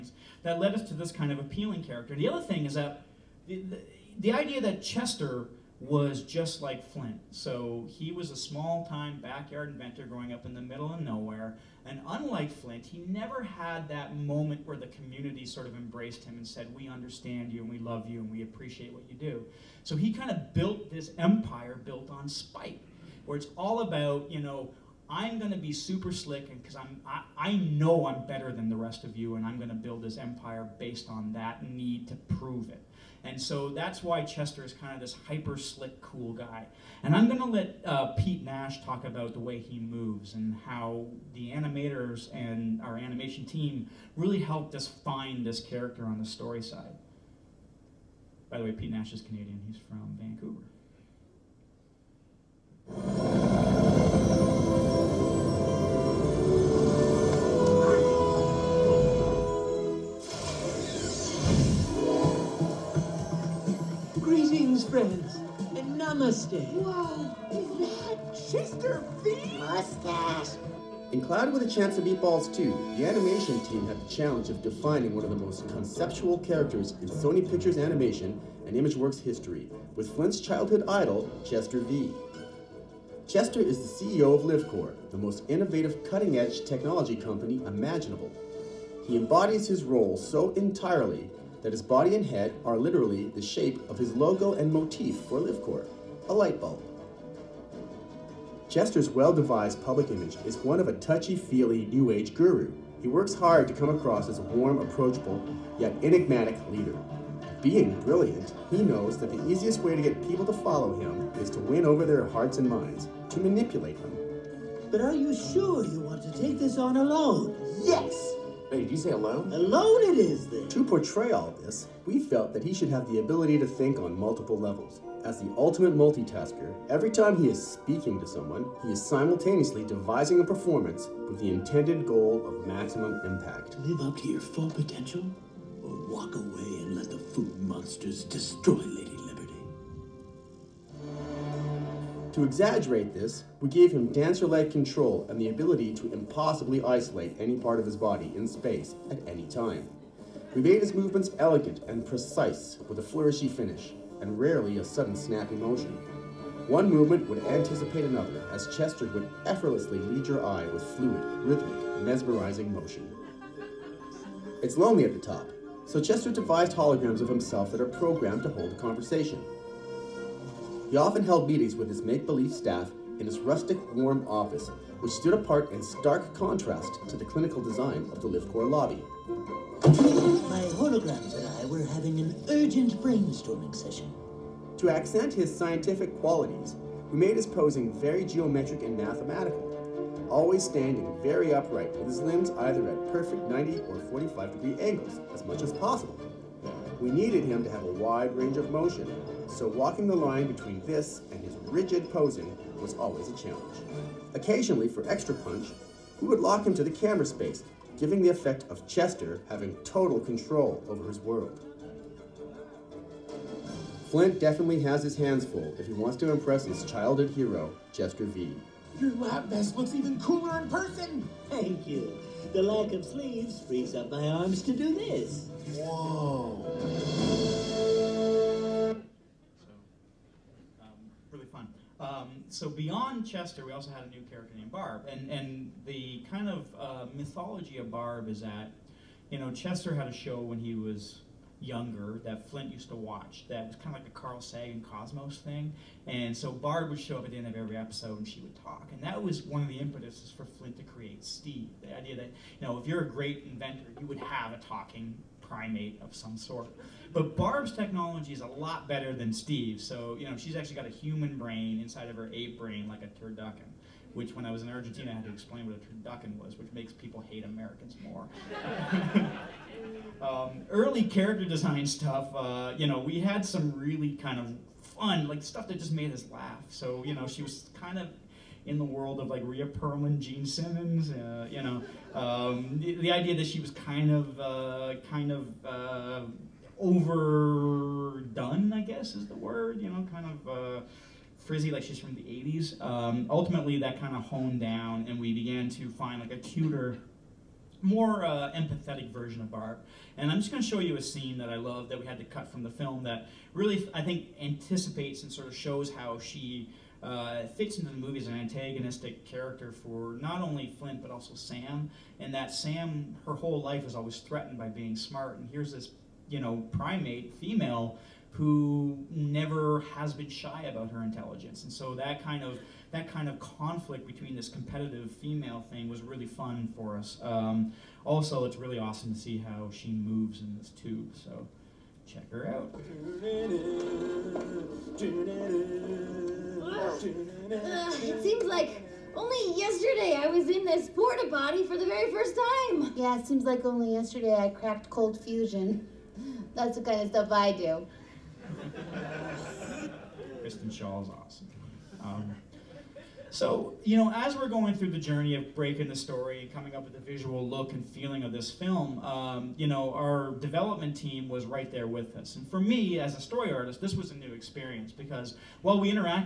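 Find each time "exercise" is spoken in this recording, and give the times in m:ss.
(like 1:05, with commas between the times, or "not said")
not said.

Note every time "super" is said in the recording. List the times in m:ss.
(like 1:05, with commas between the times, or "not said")
0:25.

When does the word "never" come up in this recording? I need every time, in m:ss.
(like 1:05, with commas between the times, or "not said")
0:13, 5:19.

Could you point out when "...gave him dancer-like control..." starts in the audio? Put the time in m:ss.
2:23.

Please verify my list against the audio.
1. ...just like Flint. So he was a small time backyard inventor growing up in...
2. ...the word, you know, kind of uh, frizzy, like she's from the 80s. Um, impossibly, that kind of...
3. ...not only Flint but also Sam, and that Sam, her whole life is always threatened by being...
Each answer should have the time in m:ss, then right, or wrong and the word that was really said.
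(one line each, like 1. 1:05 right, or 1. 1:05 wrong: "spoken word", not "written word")
1. 0:06 right
2. 4:49 wrong: "ultimately", not "impossibly"
3. 5:10 right.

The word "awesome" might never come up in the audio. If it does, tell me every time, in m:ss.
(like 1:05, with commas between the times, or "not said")
5:28, 5:51.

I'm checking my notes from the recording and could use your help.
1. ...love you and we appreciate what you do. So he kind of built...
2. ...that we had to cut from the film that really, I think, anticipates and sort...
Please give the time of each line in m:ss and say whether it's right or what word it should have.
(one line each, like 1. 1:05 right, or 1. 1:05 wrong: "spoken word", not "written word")
1. 0:17 right
2. 5:01 right.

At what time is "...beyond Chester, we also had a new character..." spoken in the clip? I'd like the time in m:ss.
3:52.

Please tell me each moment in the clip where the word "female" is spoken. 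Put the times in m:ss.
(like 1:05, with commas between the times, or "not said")
5:17, 5:25.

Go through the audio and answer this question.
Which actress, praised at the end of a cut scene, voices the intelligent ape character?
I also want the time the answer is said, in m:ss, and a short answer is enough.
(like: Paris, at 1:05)
Kristen Schaal, at 5:50.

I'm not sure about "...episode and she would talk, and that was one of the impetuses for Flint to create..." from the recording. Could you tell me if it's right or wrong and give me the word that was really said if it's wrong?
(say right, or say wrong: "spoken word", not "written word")
right.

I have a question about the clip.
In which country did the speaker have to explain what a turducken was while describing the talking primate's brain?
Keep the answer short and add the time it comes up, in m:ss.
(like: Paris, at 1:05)
Argentina, at 4:24.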